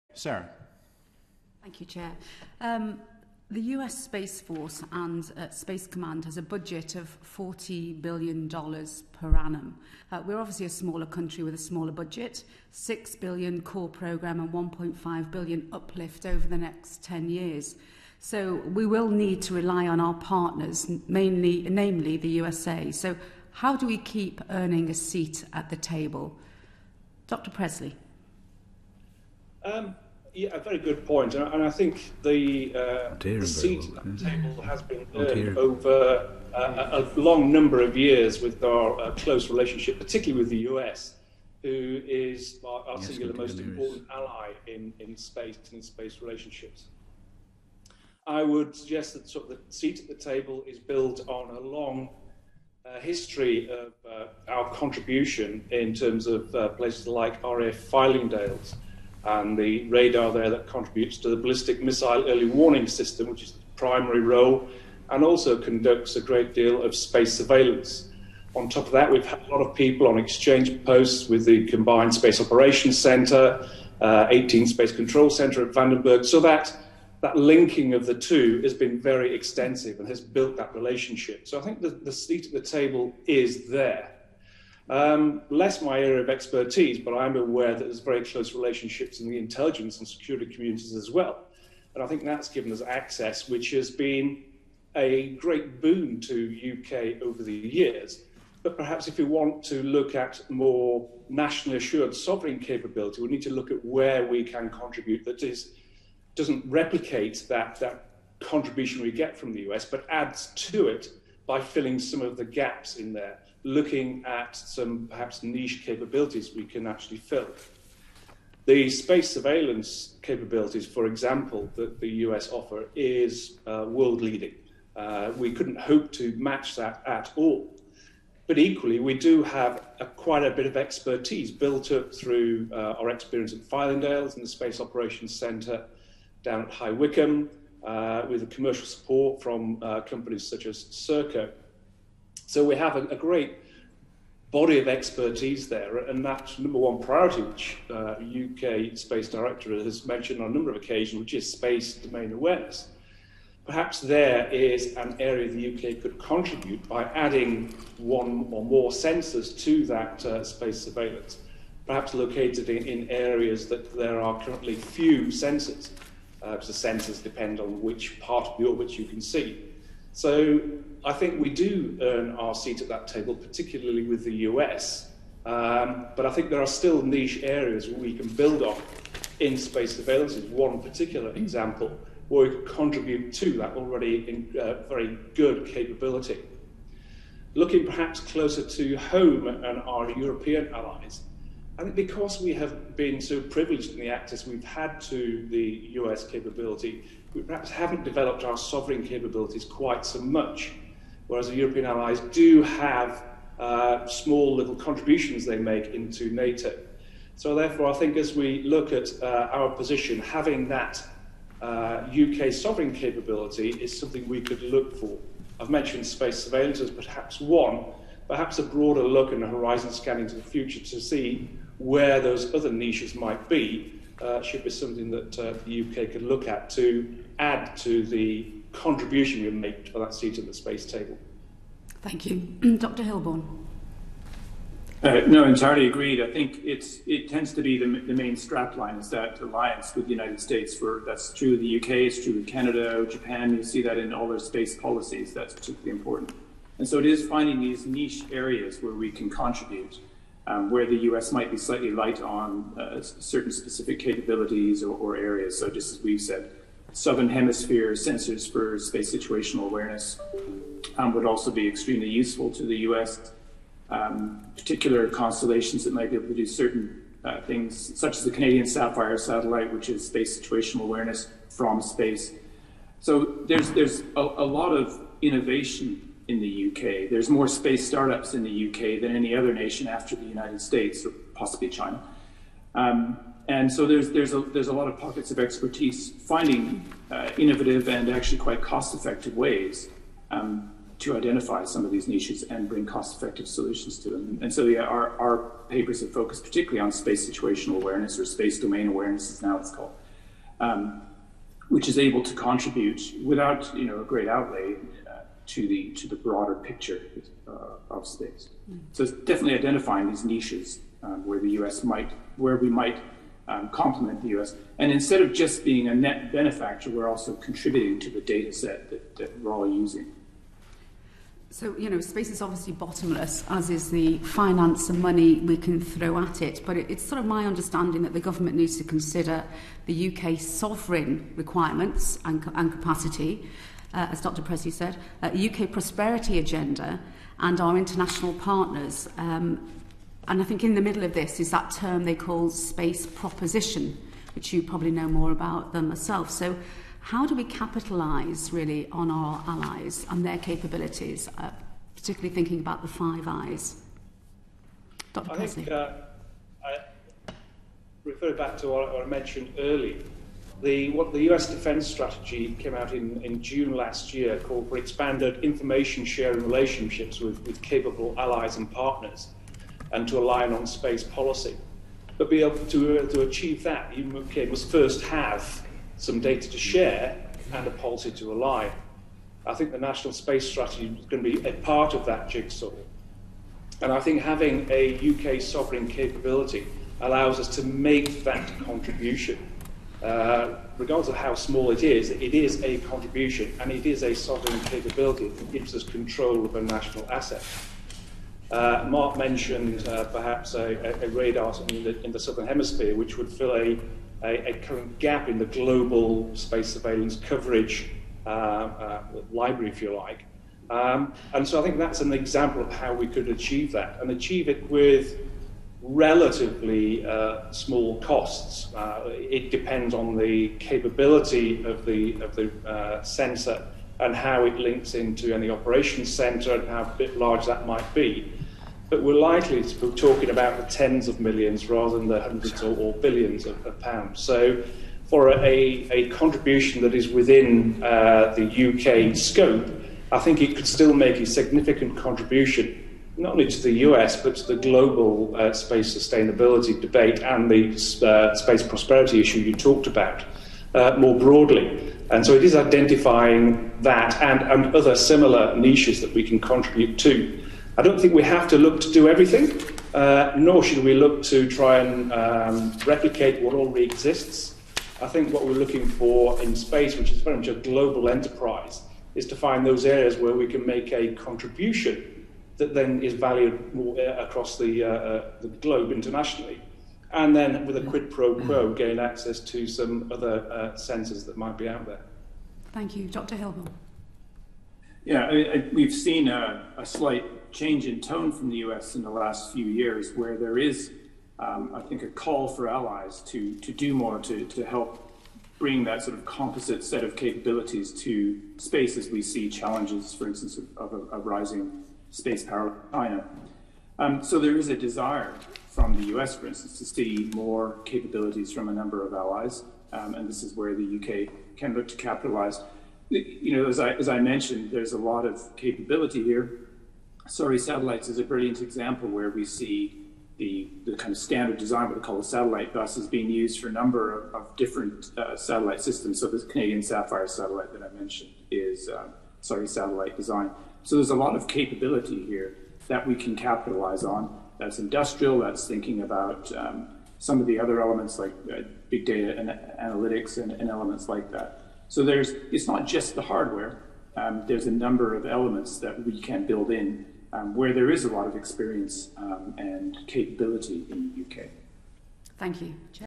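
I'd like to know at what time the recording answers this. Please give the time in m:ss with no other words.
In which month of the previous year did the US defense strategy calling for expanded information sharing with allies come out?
6:03.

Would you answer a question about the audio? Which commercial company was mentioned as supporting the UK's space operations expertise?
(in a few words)
Serco.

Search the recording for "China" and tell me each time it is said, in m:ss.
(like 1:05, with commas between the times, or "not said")
4:41, 8:22.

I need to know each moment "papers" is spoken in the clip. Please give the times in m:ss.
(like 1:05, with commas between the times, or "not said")
4:55.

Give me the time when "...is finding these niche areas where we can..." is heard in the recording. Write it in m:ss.
4:07.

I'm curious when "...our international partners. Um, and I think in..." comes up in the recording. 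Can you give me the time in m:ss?
5:37.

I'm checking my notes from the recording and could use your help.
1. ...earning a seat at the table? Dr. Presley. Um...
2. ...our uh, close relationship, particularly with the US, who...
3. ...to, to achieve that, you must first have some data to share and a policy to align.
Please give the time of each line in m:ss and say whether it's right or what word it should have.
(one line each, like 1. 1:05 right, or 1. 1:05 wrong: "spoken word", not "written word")
1. 0:24 right
2. 0:38 right
3. 6:12 right.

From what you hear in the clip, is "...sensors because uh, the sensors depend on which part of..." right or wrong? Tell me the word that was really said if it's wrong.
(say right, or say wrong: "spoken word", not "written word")
right.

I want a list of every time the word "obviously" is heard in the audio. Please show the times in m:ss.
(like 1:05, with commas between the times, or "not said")
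0:10, 5:22.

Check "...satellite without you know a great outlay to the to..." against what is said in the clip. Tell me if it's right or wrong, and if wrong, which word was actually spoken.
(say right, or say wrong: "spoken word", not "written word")
wrong: "contribute", not "satellite".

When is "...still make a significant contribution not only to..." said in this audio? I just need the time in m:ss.
7:20.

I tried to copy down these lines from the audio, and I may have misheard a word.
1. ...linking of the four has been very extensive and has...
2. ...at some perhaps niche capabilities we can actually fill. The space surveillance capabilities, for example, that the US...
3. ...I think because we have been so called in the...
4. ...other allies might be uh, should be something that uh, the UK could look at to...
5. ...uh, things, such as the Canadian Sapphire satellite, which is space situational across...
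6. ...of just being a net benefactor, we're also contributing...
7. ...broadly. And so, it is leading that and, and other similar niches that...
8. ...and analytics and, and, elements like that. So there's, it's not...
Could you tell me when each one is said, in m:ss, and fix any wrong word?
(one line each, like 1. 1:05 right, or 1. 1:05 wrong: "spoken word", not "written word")
1. 1:17 wrong: "two", not "four"
2. 1:54 right
3. 3:11 wrong: "privileged", not "called"
4. 3:42 wrong: "niches", not "allies"
5. 4:27 wrong: "awareness", not "across"
6. 5:15 right
7. 7:31 wrong: "identifying", not "leading"
8. 8:59 right.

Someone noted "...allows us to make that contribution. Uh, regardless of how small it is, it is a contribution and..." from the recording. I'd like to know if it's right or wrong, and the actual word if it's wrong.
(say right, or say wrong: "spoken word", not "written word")
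right.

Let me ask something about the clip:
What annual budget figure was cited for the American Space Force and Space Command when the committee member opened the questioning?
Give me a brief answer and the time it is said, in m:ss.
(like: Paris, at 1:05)
$40 billion, at 0:07.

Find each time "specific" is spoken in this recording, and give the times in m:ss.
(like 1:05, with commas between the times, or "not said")
4:13.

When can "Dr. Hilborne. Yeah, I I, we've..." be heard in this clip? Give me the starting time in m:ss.
8:03.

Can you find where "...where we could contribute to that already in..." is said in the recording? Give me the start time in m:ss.
3:02.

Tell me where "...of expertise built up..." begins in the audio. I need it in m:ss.
2:10.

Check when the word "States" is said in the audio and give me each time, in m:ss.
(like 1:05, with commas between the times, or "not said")
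4:00, 4:40.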